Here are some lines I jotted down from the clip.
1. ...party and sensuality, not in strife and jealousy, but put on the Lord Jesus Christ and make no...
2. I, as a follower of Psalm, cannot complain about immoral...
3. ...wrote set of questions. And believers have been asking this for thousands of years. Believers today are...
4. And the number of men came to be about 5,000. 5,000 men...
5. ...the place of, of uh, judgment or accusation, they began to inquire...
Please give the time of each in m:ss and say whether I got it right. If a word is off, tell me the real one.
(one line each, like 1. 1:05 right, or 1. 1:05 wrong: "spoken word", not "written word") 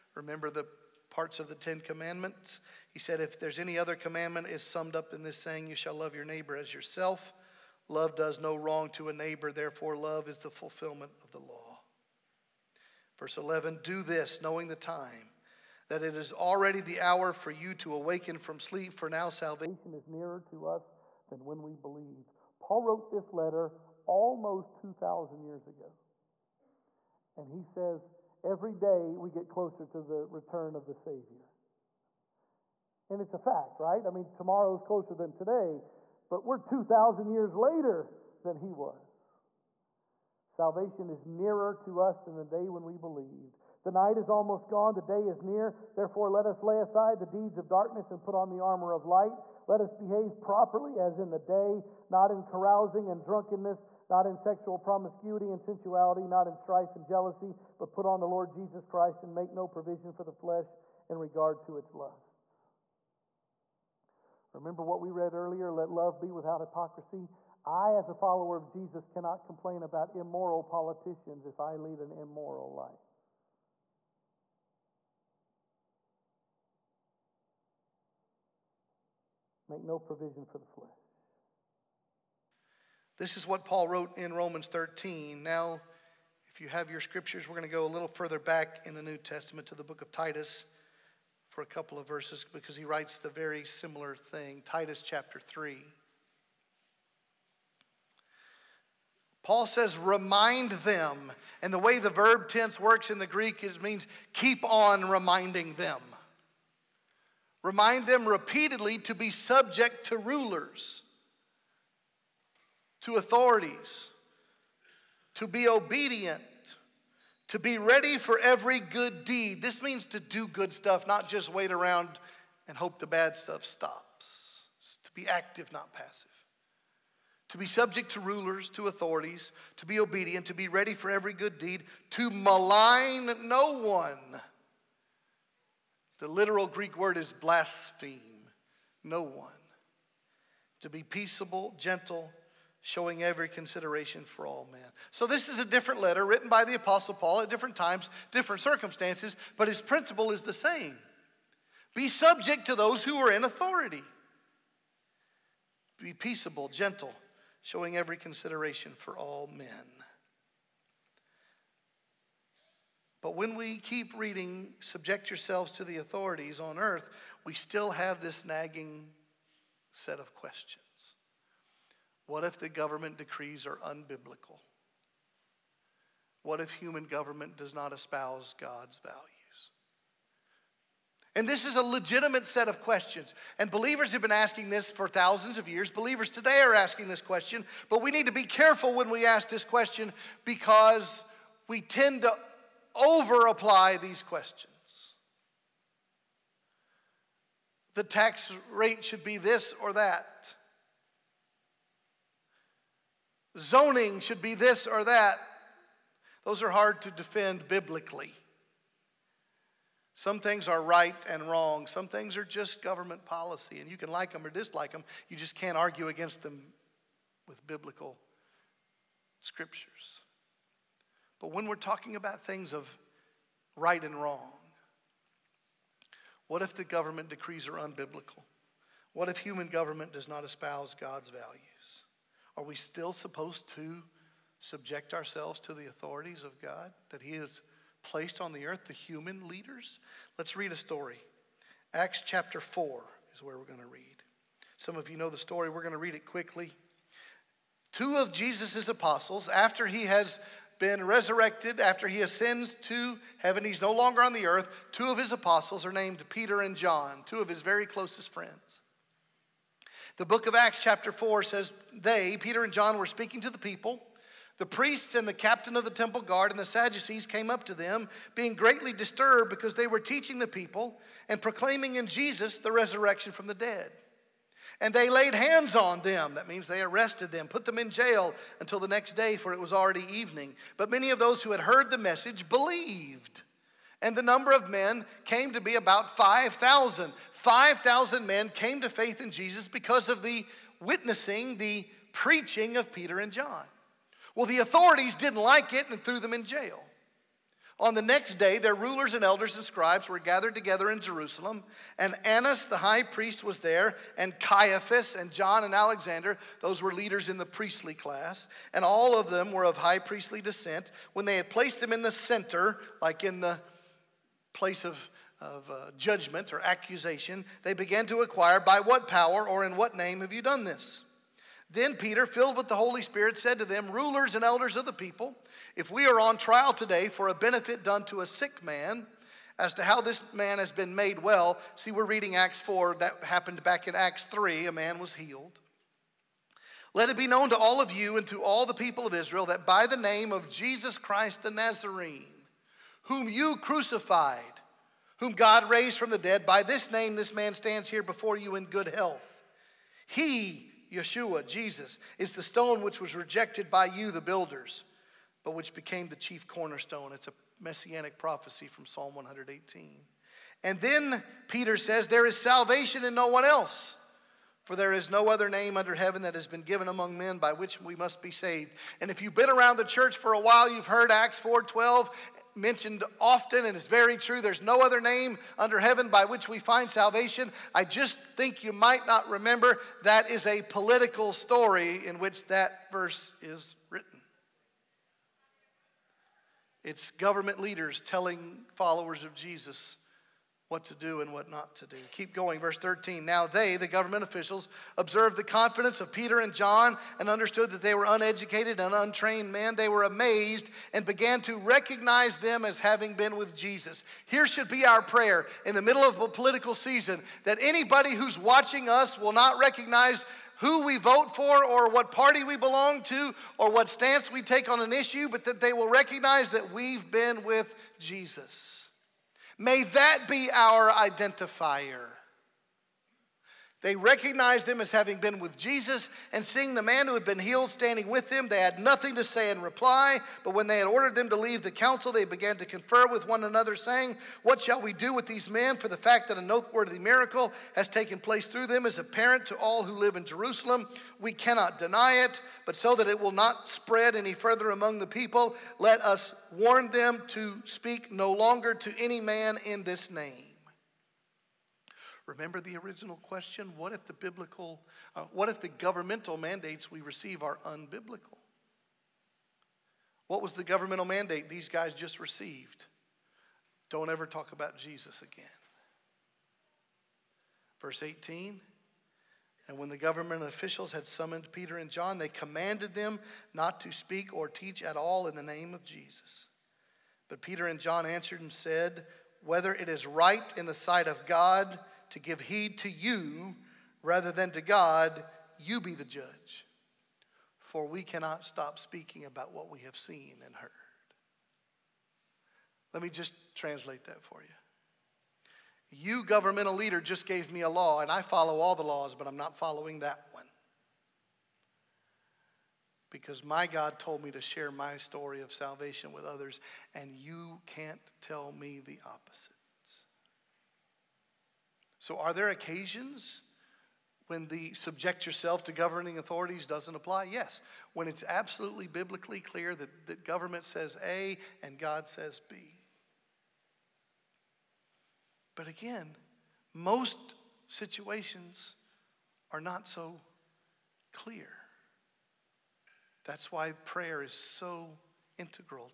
1. 0:54 wrong: "promiscuity", not "party"
2. 1:07 wrong: "Jesus", not "Psalm"
3. 3:01 wrong: "legitimate", not "wrote"
4. 4:44 right
5. 5:13 right.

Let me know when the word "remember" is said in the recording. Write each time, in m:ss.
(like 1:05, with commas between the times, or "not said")
0:00, 1:04, 6:19, 7:32.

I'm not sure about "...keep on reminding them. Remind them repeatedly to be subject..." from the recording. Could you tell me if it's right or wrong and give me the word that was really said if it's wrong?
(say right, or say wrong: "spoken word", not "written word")
right.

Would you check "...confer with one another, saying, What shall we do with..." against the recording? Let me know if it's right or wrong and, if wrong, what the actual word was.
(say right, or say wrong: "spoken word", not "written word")
right.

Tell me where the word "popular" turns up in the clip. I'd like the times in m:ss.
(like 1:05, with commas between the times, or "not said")
not said.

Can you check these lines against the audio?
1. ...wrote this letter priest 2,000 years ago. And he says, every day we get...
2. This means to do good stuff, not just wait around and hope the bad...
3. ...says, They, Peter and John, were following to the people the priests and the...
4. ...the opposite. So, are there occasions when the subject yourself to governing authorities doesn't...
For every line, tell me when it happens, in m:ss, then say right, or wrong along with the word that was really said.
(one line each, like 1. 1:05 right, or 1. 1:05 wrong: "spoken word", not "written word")
1. 0:22 wrong: "almost", not "priest"
2. 1:59 right
3. 4:21 wrong: "speaking", not "following"
4. 8:28 right.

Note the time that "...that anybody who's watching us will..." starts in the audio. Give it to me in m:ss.
6:47.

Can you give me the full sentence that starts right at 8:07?
For we cannot stop speaking about what we have seen and heard.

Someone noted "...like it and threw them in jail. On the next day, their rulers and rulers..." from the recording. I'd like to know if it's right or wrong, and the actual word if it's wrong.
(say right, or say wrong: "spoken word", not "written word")
wrong: "elders", not "rulers".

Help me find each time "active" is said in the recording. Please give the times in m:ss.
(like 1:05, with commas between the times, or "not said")
2:05.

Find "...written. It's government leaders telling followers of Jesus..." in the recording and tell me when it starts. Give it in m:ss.
6:23.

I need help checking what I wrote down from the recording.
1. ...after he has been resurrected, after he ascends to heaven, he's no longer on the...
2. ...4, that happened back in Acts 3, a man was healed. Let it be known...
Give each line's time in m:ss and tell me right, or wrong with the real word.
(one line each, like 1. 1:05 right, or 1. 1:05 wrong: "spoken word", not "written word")
1. 4:09 right
2. 5:32 right.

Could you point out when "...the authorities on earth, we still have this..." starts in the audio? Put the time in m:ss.
2:45.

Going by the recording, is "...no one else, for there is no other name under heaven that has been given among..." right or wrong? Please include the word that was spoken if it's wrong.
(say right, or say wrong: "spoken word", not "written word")
right.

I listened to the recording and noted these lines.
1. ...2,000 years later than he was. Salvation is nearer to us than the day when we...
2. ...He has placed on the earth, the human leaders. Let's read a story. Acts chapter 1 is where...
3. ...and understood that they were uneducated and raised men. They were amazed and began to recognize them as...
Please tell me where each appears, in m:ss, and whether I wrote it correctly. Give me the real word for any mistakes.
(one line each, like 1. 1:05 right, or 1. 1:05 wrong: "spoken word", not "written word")
1. 0:36 right
2. 3:57 wrong: "4", not "1"
3. 6:37 wrong: "untrained", not "raised".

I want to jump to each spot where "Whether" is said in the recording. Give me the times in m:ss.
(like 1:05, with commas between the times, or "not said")
7:59.